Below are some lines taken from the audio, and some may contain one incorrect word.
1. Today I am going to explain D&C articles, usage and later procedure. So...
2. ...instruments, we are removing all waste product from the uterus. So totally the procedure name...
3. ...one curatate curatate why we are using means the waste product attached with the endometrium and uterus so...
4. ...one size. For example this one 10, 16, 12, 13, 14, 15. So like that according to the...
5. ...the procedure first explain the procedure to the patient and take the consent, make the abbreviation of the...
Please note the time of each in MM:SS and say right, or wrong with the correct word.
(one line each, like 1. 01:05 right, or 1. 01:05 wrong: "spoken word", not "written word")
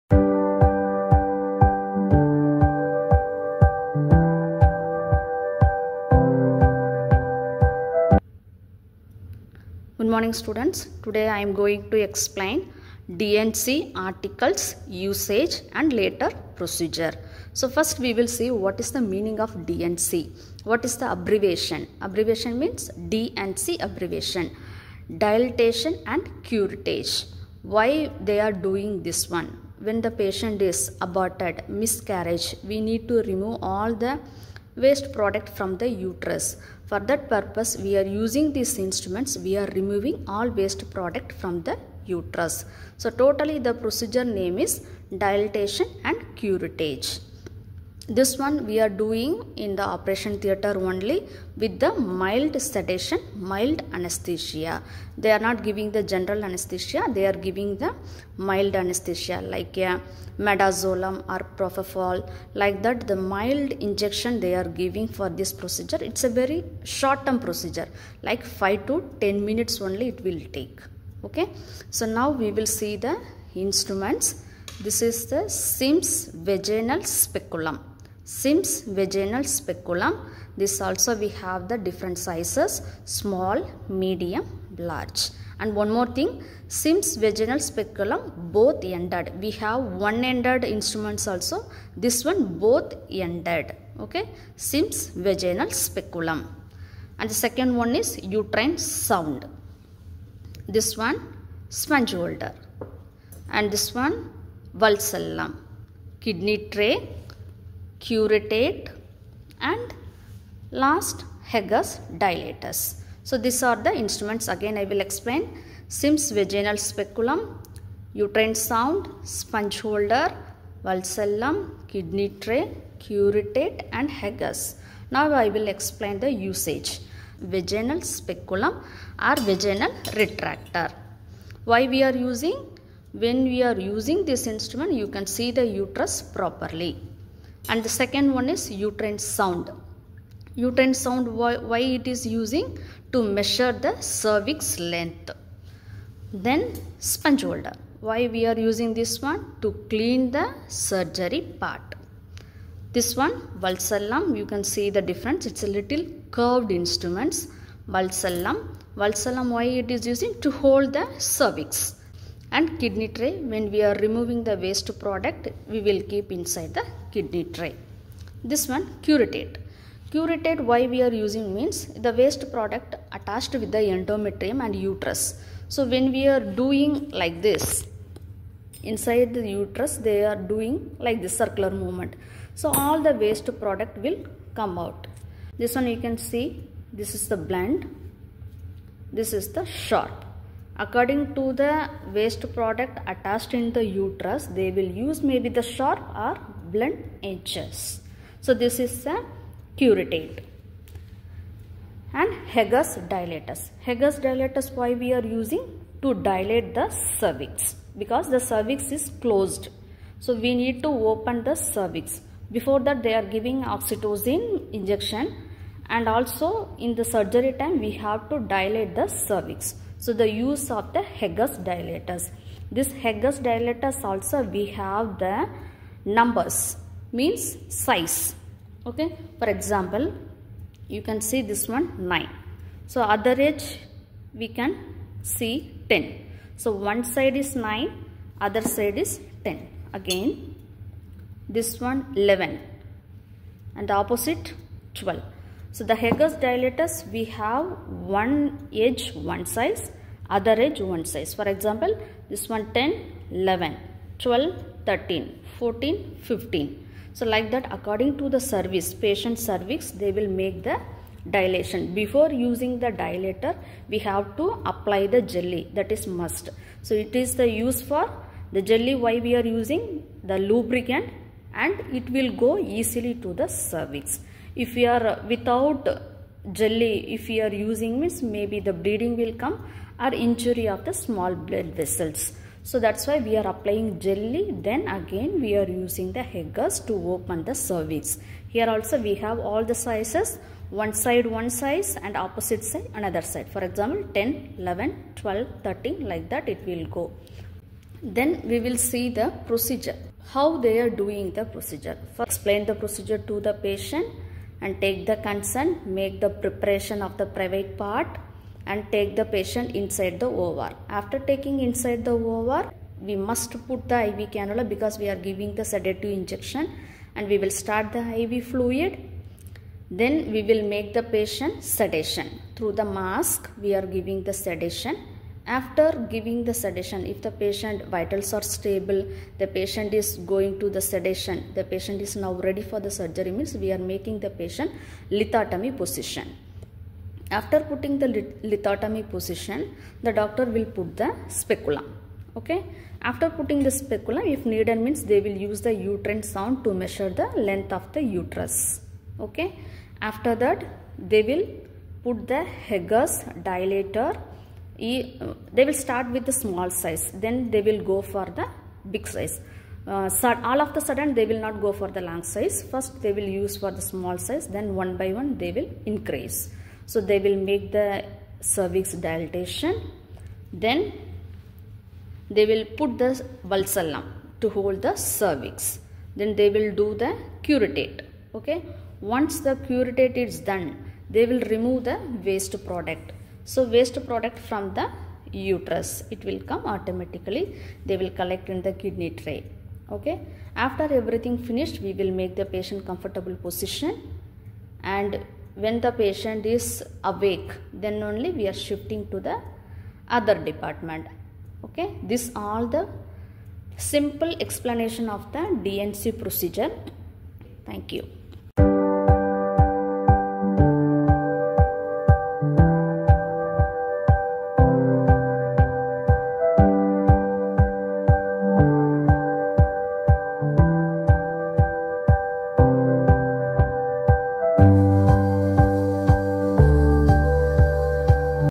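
1. 00:11 right
2. 00:38 right
3. 02:48 right
4. 04:10 wrong: "11", not "16"
5. 05:01 wrong: "preparation", not "abbreviation".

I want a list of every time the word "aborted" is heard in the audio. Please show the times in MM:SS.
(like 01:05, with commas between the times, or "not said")
00:30.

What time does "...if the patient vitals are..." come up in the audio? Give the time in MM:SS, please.
05:27.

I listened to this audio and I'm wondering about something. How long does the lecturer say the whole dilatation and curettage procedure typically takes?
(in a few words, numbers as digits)
5 to 10 minutes.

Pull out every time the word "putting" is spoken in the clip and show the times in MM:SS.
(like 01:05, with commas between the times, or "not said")
05:37, 05:43.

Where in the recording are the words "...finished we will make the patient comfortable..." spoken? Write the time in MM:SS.
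06:31.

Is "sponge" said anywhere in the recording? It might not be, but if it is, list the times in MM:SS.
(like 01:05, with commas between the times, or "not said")
01:41, 01:59, 02:26.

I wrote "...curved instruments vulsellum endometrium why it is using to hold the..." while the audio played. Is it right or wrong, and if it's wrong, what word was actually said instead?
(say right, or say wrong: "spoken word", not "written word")
wrong: "vulsellum", not "endometrium".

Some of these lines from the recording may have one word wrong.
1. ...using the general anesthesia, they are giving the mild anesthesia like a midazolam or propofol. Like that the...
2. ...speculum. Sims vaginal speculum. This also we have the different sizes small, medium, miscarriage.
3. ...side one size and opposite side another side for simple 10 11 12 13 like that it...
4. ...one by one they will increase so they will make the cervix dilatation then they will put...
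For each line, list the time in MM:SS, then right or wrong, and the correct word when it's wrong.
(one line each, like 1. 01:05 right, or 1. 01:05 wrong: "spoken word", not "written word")
1. 00:55 wrong: "giving", not "using"
2. 01:17 wrong: "large", not "miscarriage"
3. 04:50 wrong: "example", not "simple"
4. 06:04 right.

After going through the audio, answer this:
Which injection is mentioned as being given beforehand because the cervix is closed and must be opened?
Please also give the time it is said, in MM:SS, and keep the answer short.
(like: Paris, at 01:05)
Oxytocin, at 03:33.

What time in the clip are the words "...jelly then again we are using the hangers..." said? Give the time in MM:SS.
04:43.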